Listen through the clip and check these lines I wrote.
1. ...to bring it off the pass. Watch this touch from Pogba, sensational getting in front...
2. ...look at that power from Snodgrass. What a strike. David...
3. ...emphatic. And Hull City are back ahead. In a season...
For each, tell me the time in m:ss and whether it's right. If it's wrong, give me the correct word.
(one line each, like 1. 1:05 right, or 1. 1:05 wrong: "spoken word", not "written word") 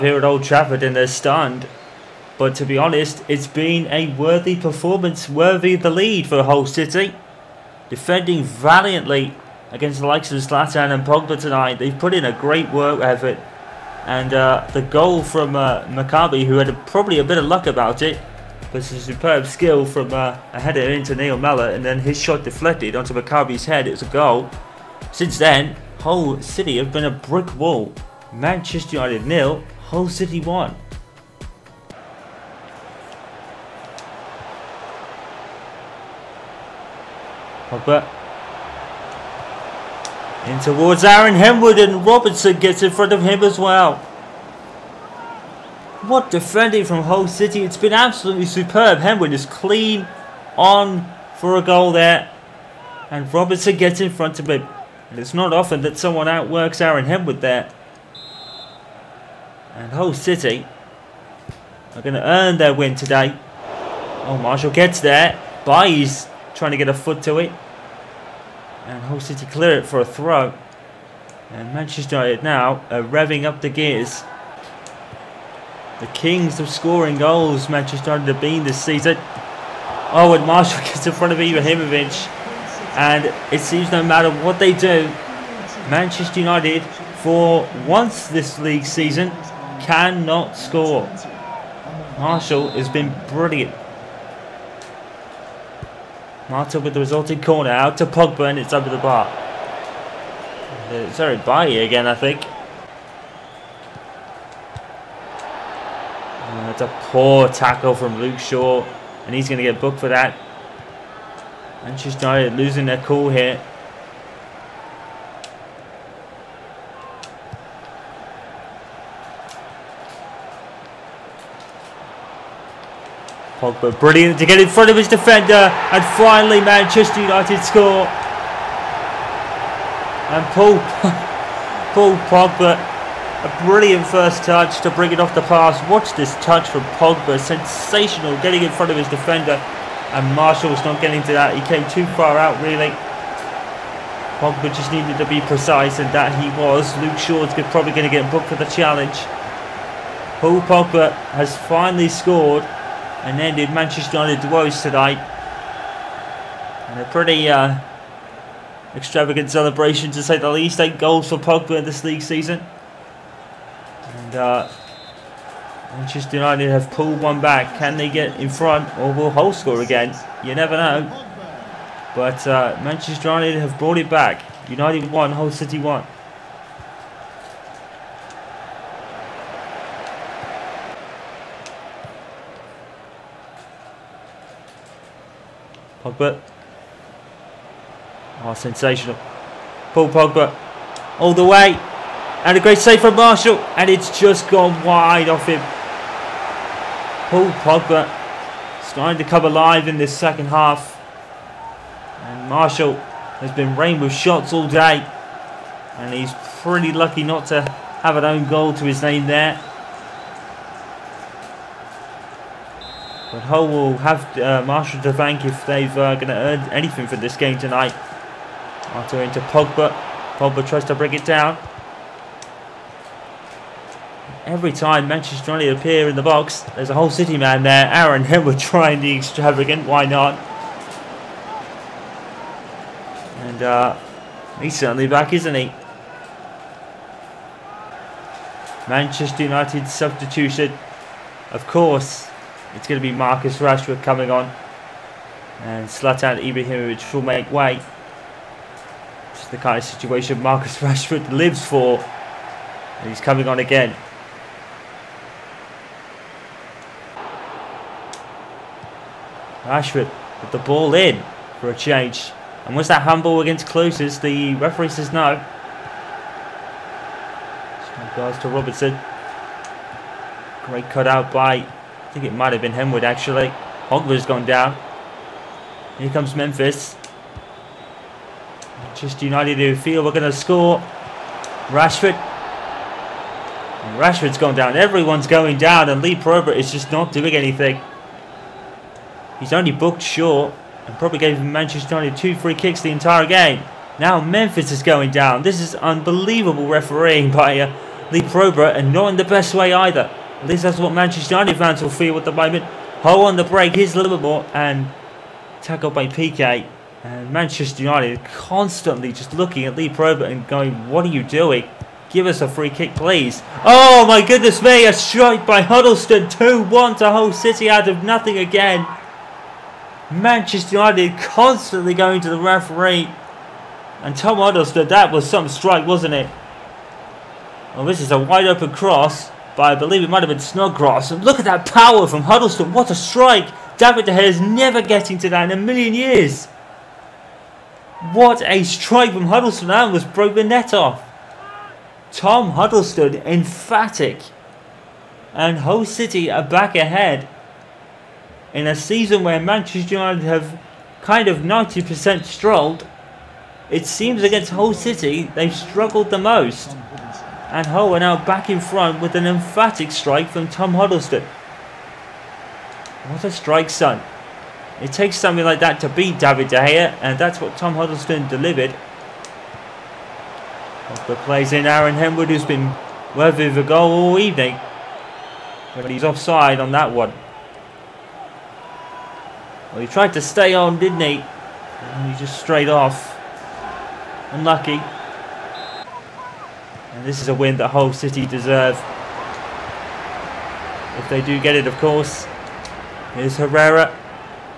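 1. 2:14 right
2. 5:31 wrong: "Huddlestone", not "Snodgrass"
3. 5:43 right.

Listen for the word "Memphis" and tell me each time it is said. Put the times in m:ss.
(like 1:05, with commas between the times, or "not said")
4:36, 4:54.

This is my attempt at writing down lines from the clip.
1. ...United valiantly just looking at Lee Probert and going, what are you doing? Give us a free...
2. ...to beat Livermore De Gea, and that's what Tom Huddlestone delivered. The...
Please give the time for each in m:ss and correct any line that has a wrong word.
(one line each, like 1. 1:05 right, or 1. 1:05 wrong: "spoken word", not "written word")
1. 5:07 wrong: "constantly", not "valiantly"
2. 6:05 wrong: "David", not "Livermore".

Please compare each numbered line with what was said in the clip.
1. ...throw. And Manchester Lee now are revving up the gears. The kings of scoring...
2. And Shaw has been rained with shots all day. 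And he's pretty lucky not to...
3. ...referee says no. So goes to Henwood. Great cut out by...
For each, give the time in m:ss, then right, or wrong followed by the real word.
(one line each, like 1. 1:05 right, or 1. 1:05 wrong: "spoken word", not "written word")
1. 1:10 wrong: "United", not "Lee"
2. 3:22 wrong: "Marshall", not "Shaw"
3. 4:24 wrong: "Robertson", not "Henwood".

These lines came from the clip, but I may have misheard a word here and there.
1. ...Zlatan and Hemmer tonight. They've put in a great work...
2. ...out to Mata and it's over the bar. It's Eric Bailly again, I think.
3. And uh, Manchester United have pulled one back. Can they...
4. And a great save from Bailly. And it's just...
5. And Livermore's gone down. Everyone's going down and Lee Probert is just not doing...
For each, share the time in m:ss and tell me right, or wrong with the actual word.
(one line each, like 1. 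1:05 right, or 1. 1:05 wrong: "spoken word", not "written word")
1. 0:10 wrong: "Pogba", not "Hemmer"
2. 1:37 wrong: "Pogba", not "Mata"
3. 2:44 right
4. 3:12 wrong: "Marshall", not "Bailly"
5. 4:42 wrong: "Rashford", not "Livermore".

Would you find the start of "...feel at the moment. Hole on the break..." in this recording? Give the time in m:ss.
5:01.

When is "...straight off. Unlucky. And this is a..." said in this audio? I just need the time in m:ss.
6:22.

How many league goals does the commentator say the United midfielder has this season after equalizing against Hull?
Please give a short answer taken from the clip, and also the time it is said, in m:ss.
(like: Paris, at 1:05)
8, at 2:40.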